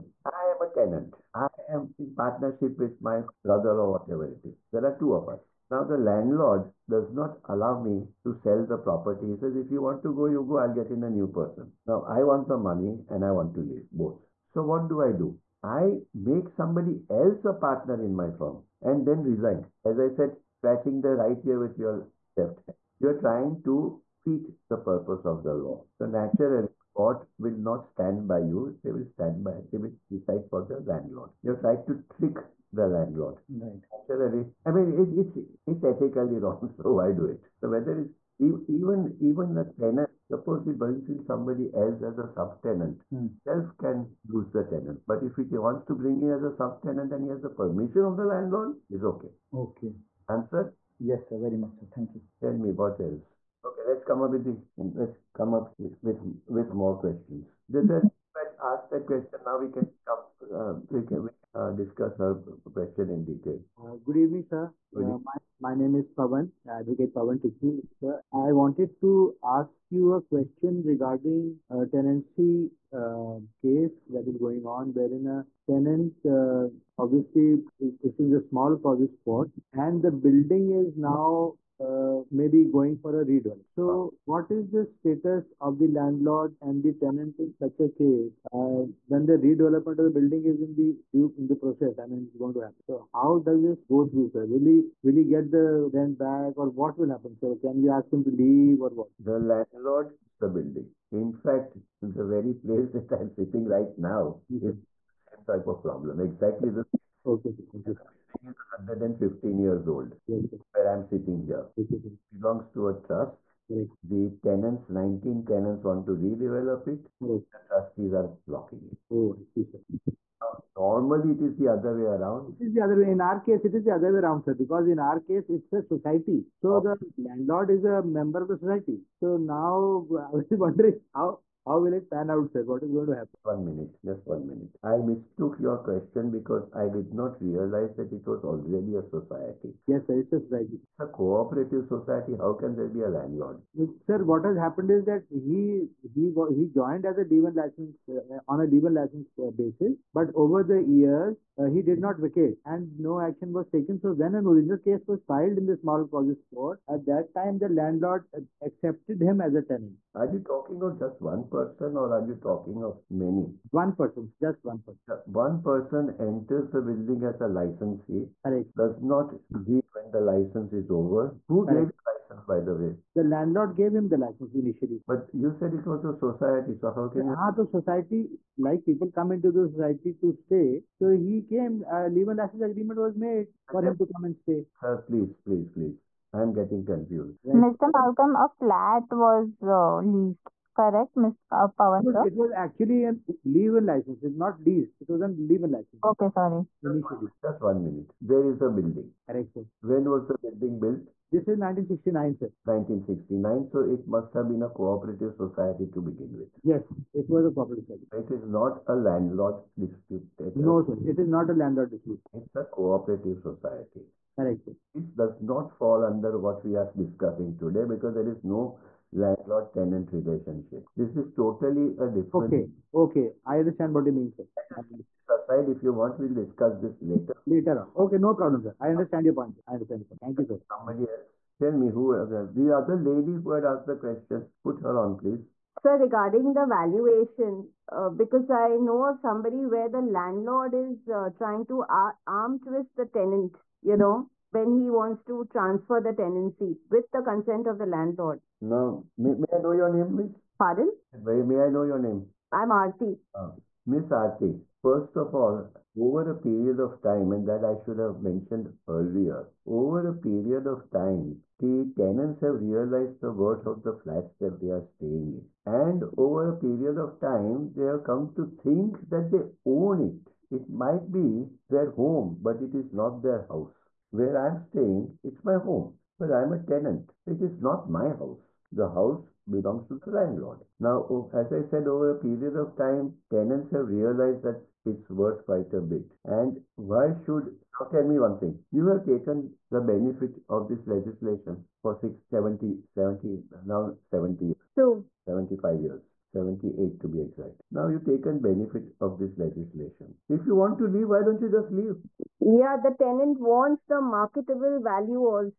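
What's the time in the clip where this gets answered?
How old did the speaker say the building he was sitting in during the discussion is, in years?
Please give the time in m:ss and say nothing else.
1:49.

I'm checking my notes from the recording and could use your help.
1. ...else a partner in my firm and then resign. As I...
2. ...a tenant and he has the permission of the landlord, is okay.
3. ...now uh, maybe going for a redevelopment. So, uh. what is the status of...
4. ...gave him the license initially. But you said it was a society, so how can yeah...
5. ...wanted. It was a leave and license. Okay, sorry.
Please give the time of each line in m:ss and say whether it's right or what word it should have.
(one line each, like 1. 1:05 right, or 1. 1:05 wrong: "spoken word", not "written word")
1. 0:17 right
2. 0:46 wrong: "subtenant", not "tenant"
3. 1:20 right
4. 2:53 right
5. 3:14 wrong: "leased", not "wanted".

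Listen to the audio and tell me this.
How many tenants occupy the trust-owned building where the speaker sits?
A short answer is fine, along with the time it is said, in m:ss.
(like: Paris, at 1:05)
19, at 1:54.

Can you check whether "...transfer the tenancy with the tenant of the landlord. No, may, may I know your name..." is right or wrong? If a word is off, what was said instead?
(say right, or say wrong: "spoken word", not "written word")
wrong: "consent", not "tenant".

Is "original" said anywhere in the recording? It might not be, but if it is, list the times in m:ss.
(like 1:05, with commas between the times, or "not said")
2:34.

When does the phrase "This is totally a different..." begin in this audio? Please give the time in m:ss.
3:40.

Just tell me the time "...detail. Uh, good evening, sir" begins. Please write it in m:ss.
1:03.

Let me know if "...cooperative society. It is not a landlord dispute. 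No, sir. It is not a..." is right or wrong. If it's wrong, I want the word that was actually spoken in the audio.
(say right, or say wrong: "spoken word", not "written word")
right.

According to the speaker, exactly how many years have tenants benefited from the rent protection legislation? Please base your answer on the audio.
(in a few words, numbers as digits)
78.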